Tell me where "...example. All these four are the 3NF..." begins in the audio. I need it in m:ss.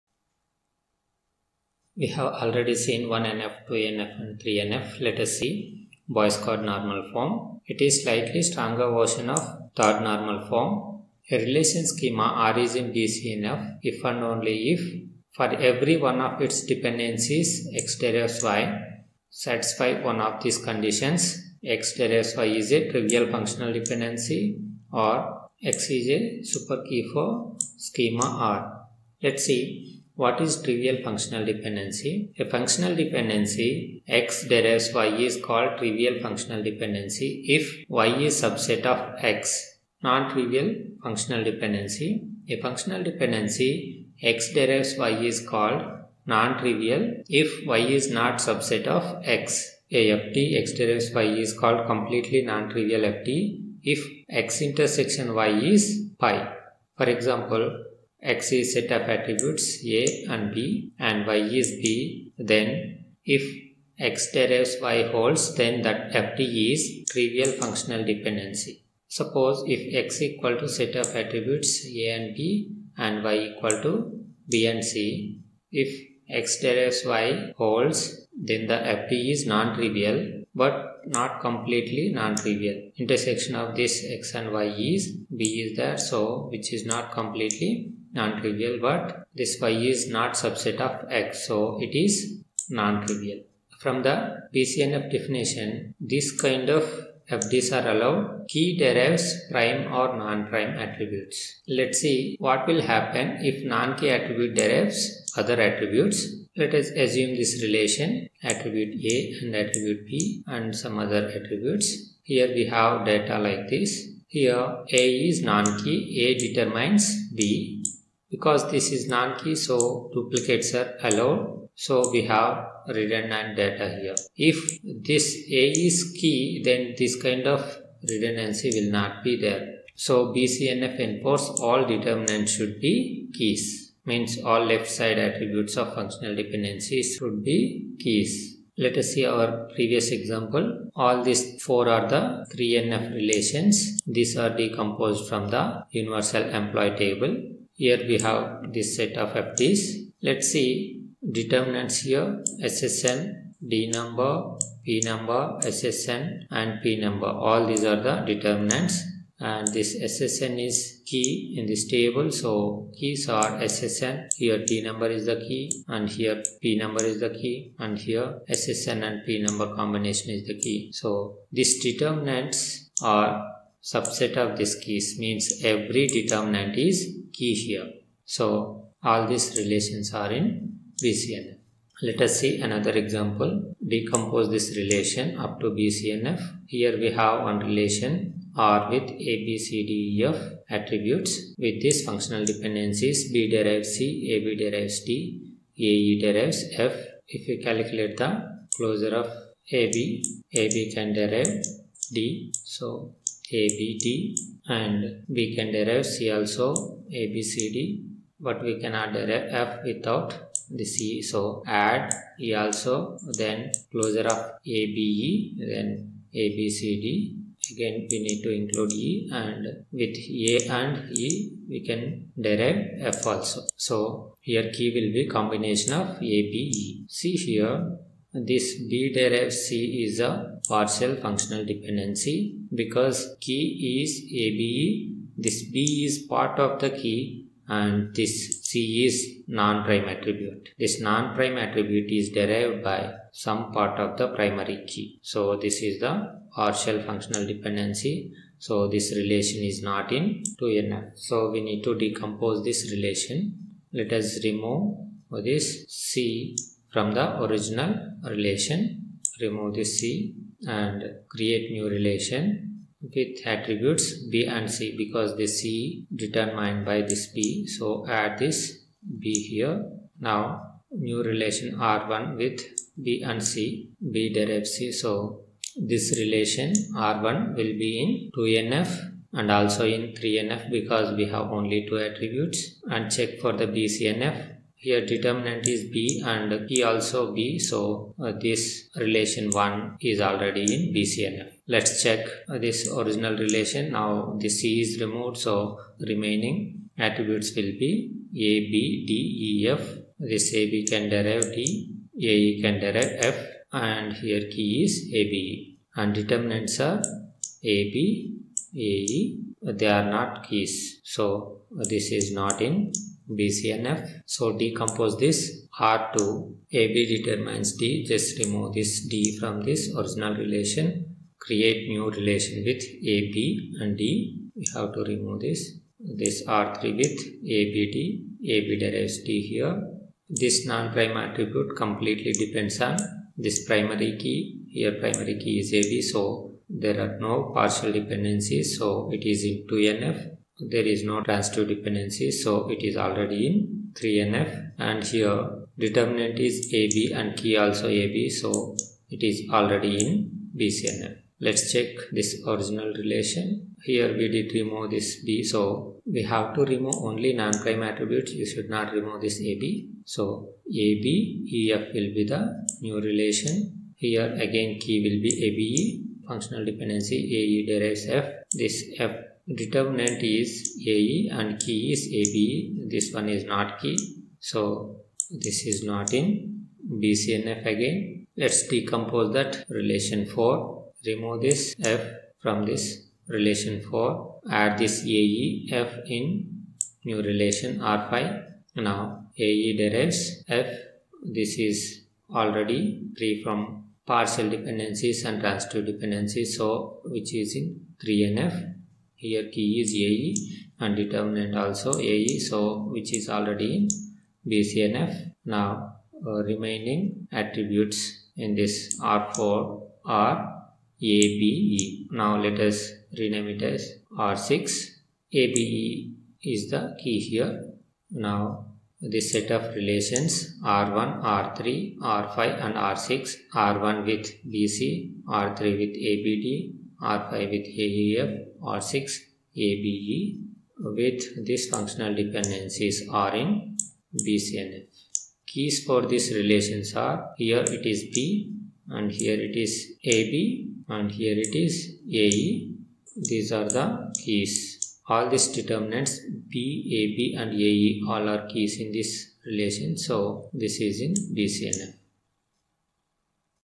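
2:20.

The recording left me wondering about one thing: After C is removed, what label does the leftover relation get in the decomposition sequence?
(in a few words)
R2.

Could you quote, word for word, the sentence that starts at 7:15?
Keys for these relations are here it is B and here it is AB and here it is AE.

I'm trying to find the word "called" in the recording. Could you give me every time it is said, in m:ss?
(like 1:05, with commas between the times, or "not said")
0:35, 0:45, 0:51.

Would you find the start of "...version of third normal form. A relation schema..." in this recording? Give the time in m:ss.
0:08.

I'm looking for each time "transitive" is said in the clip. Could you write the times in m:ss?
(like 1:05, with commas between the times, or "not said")
5:41, 6:35.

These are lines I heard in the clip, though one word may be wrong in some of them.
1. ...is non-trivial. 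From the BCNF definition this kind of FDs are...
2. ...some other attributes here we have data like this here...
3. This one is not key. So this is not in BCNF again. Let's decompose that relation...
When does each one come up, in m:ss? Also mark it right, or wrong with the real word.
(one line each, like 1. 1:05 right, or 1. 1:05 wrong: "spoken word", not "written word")
1. 1:32 right
2. 1:50 right
3. 6:12 right.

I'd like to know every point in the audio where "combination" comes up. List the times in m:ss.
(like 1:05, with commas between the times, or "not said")
2:49, 3:45.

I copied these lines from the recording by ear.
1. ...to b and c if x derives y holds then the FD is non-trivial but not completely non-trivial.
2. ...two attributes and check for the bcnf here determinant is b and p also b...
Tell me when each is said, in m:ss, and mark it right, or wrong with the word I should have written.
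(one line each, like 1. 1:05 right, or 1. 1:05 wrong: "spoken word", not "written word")
1. 1:13 right
2. 4:41 right.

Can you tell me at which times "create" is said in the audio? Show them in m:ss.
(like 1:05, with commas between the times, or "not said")
4:21, 5:21.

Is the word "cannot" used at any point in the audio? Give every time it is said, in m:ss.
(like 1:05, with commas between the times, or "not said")
3:28.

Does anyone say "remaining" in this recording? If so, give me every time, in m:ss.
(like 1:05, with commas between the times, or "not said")
4:56, 6:46.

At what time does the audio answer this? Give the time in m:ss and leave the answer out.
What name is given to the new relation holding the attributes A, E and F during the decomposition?
6:27.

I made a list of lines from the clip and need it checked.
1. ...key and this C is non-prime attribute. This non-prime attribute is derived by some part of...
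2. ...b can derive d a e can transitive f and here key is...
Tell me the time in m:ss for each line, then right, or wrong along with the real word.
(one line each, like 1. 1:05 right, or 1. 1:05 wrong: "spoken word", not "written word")
1. 3:57 right
2. 5:00 wrong: "derive", not "transitive".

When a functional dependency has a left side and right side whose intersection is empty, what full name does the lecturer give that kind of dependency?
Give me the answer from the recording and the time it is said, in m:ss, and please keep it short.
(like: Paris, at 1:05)
completely non-trivial FD, at 0:51.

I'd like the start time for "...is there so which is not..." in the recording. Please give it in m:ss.
1:25.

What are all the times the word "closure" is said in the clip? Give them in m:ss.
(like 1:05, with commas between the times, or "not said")
3:18, 3:33.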